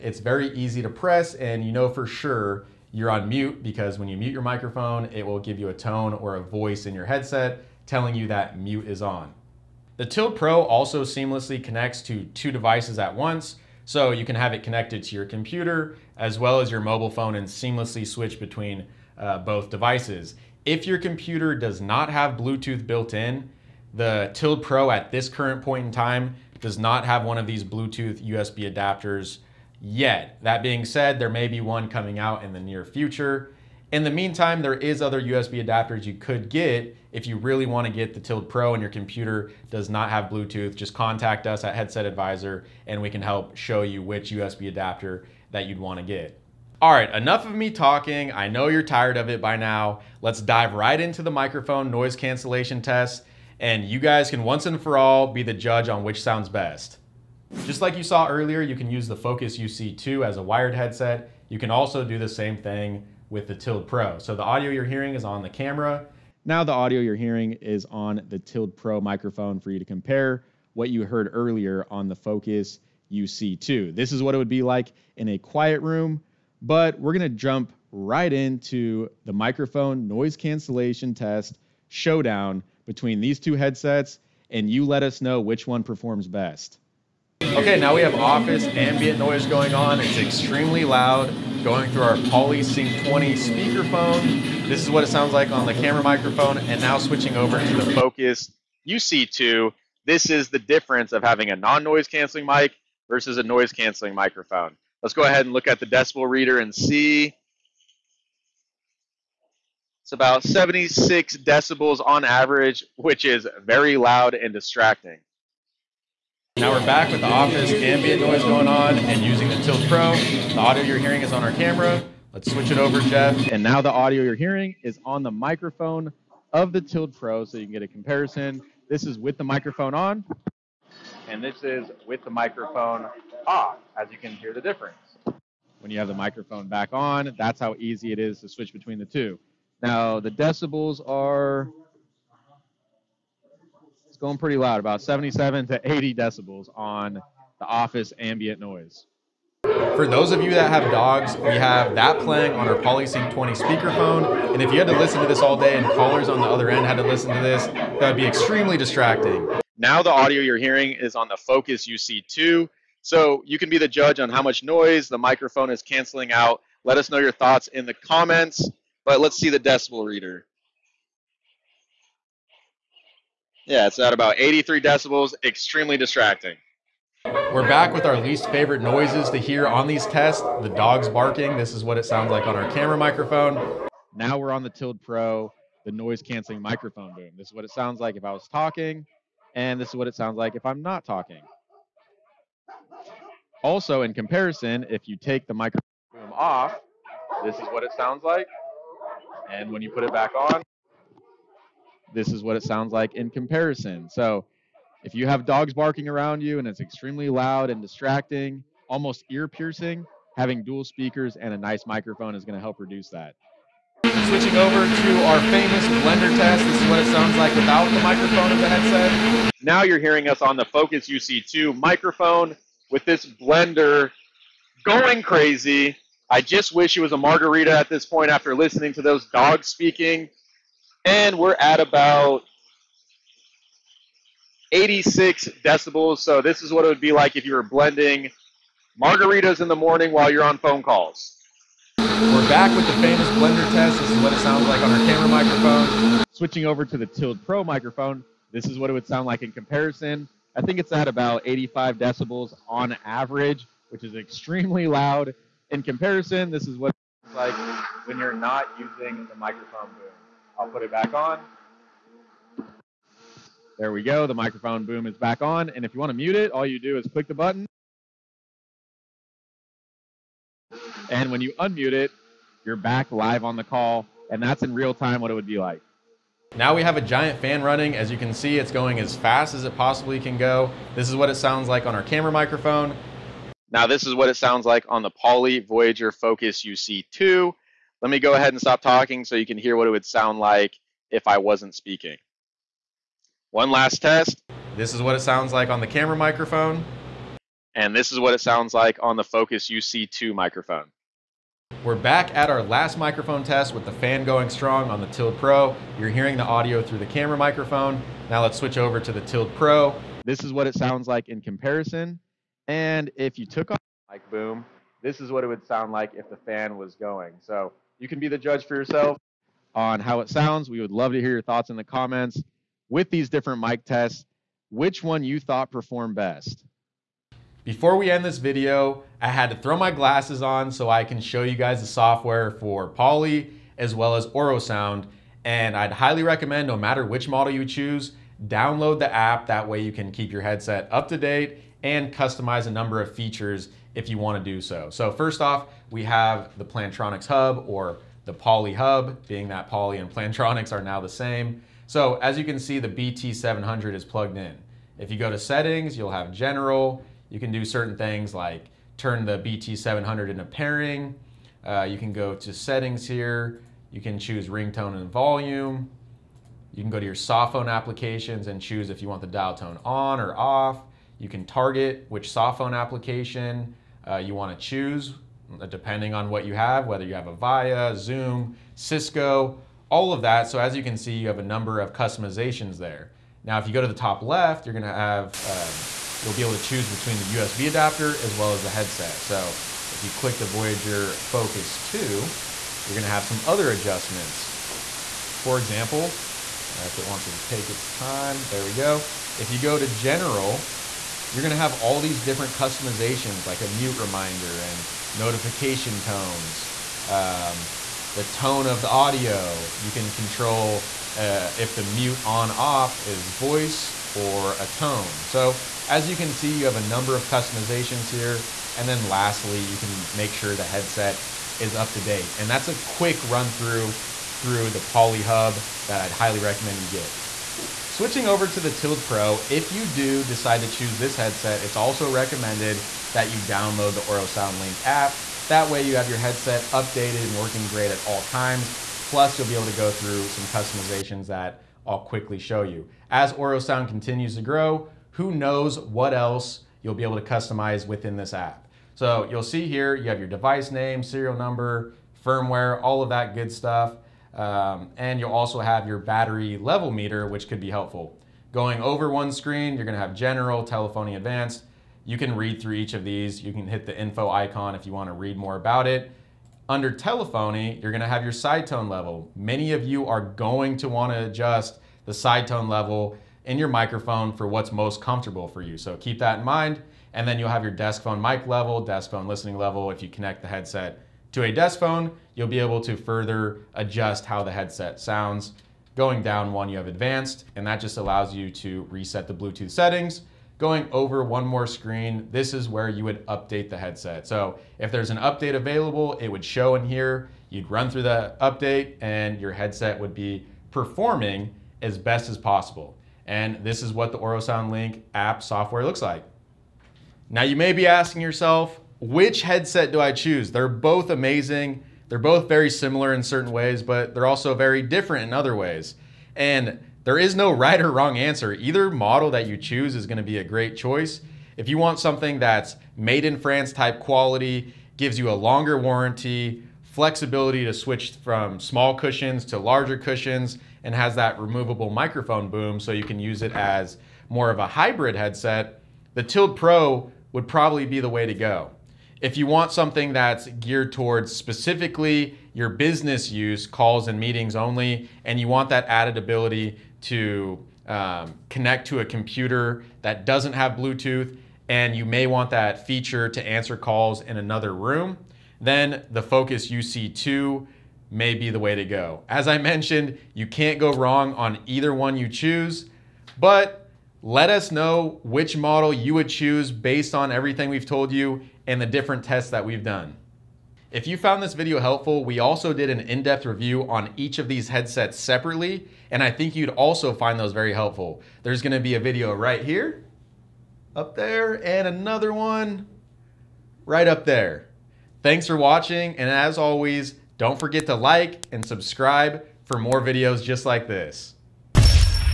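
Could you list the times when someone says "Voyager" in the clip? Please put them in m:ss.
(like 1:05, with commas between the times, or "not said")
4:45, 6:30.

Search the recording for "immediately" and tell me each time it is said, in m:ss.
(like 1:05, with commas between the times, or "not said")
not said.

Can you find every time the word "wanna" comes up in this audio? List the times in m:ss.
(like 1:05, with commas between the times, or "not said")
7:44, 7:50.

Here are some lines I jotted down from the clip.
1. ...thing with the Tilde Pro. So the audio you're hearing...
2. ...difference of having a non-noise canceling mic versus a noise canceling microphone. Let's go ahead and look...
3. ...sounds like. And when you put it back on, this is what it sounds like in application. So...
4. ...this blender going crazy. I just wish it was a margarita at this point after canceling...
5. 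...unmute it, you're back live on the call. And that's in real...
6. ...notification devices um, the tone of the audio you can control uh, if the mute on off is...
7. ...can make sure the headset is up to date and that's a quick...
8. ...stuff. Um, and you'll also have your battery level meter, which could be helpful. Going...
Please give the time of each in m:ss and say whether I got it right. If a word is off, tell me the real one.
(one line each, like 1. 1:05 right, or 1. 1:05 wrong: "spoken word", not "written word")
1. 1:02 right
2. 1:40 right
3. 3:17 wrong: "comparison", not "application"
4. 3:43 wrong: "listening", not "canceling"
5. 4:31 right
6. 6:45 wrong: "tones", not "devices"
7. 6:59 right
8. 7:33 right.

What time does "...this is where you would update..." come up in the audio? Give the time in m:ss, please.
8:12.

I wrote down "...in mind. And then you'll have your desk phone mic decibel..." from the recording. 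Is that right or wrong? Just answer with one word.
wrong.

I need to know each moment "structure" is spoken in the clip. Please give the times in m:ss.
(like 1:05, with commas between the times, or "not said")
not said.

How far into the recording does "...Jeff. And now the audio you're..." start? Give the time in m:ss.
2:02.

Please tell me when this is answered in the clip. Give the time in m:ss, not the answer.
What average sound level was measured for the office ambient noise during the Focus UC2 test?
1:50.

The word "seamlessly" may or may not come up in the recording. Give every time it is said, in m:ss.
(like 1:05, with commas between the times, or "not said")
0:11, 0:17.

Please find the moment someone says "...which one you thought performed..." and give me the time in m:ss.
5:24.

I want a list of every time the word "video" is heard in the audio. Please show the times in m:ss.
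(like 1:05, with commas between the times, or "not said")
5:28, 9:31, 9:38, 9:50.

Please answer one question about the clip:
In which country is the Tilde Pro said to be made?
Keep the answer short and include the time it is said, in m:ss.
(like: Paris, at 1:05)
France, at 8:43.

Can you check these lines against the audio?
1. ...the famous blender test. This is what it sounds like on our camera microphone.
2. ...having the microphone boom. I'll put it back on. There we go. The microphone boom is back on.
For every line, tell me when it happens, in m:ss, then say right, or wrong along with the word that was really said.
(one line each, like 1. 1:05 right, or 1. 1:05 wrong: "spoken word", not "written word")
1. 4:02 right
2. 4:18 wrong: "using", not "having".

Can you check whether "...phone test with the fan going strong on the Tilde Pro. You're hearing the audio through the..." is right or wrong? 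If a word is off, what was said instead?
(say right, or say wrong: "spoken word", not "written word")
wrong: "microphone", not "phone".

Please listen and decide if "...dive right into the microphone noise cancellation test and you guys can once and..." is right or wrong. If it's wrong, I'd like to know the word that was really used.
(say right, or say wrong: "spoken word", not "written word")
right.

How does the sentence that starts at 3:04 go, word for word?
Now we're on the Tilde Pro, the noise canceling microphone boom.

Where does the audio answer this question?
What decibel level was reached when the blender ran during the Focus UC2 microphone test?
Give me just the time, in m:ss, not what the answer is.
3:54.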